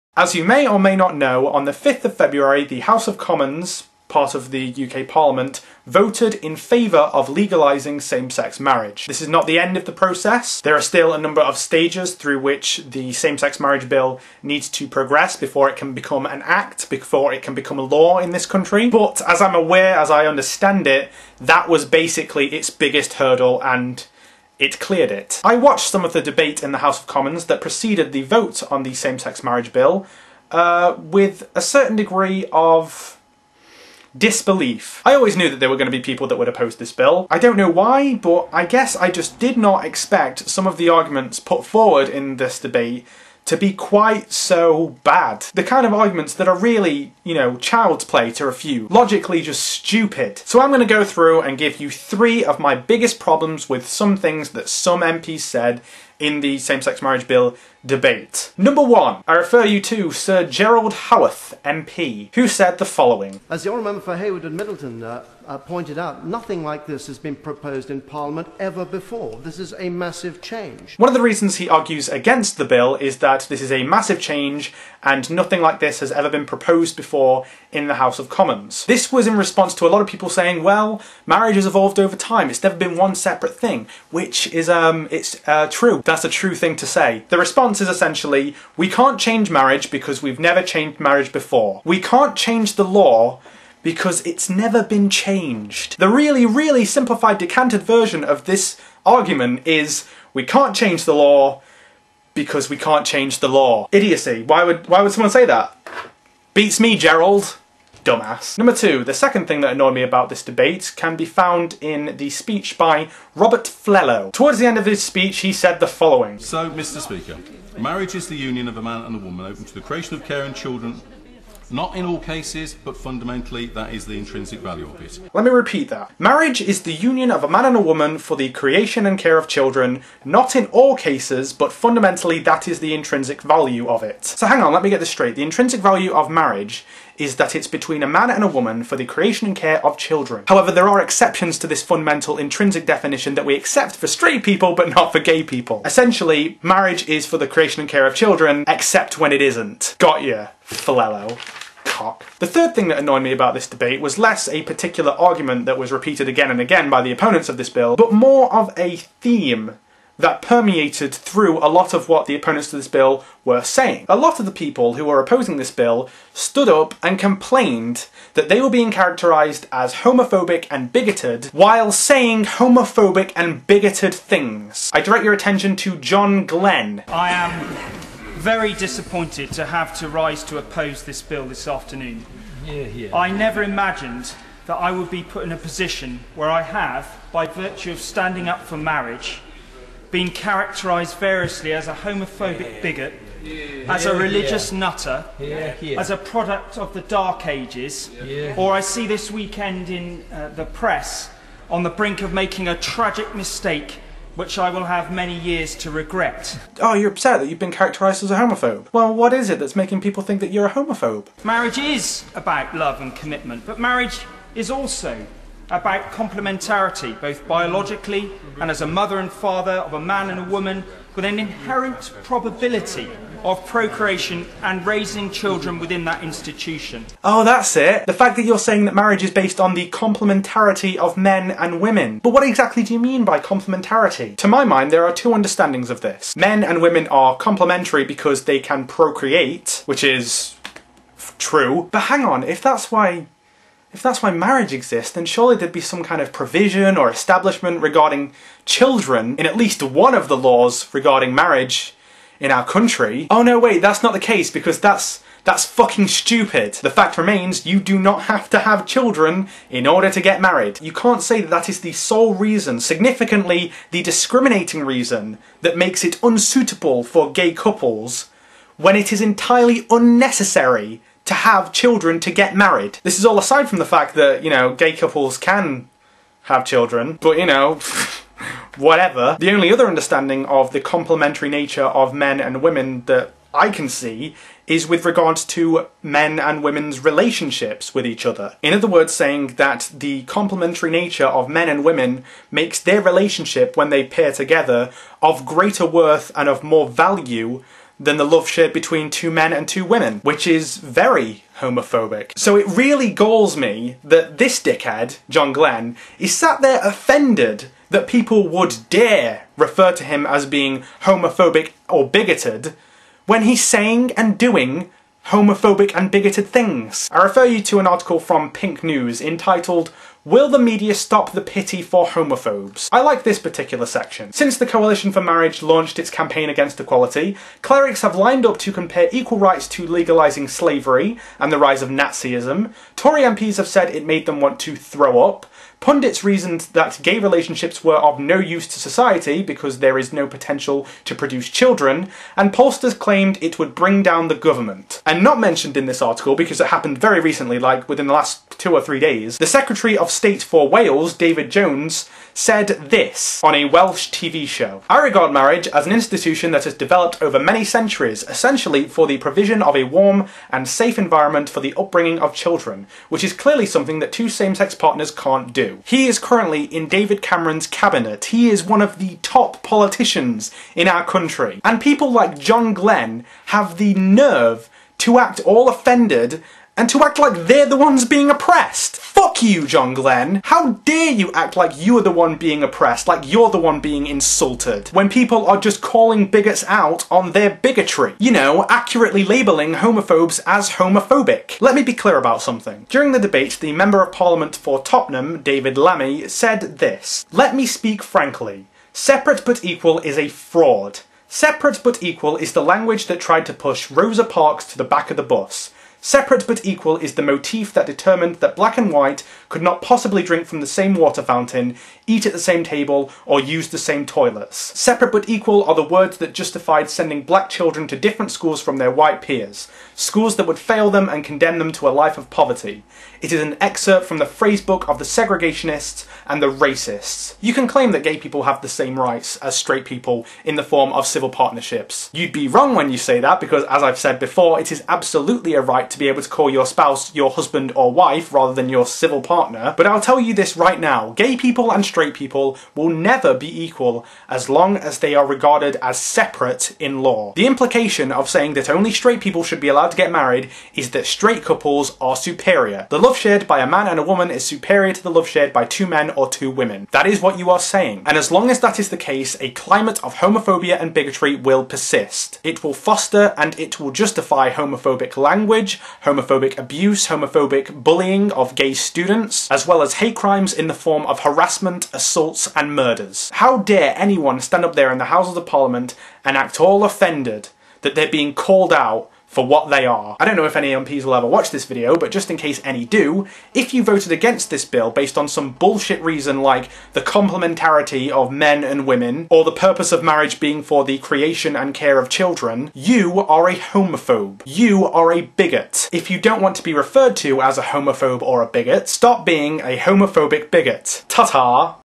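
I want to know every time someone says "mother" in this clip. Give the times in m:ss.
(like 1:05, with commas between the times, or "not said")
3:38.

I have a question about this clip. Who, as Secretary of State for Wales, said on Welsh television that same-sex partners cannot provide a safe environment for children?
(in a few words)
David Jones.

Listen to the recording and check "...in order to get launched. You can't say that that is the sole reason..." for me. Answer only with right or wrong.
wrong.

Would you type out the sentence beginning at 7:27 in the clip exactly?
The implication of saying that only straight people should be allowed to get married is that straight couples are superior.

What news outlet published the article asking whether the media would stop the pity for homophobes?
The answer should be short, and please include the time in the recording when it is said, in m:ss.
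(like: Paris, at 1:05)
Pink News, at 5:18.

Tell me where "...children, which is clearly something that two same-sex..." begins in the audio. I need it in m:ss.
6:02.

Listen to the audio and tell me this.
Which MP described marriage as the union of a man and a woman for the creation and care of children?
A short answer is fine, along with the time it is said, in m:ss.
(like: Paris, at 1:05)
Robert Flello, at 1:53.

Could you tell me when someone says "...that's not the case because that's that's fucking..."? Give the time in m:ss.
4:13.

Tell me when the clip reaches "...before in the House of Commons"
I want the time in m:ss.
1:16.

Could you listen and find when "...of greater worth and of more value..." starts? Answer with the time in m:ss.
4:55.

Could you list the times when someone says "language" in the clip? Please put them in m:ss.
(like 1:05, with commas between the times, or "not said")
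6:42, 7:45.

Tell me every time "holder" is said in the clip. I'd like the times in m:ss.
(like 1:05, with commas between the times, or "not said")
not said.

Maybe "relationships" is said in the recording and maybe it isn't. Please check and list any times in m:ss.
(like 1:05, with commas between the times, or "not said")
4:47, 4:53, 5:37.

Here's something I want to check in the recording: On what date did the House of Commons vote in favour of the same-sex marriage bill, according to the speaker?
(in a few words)
5th of February.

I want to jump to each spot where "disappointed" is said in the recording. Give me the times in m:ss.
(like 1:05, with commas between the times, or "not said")
2:58.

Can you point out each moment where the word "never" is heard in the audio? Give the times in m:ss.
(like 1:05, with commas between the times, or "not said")
1:22, 1:30, 1:34, 3:03, 7:22.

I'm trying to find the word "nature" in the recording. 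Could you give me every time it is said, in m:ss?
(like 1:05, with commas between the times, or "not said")
4:41, 4:50.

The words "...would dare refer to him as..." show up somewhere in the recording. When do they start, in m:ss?
5:08.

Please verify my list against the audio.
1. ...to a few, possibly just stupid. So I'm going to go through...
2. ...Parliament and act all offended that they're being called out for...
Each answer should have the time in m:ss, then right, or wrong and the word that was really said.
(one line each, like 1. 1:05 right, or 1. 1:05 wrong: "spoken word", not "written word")
1. 0:48 wrong: "logically", not "possibly"
2. 7:55 right.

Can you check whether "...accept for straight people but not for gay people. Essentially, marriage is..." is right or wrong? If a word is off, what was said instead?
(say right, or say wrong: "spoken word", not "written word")
right.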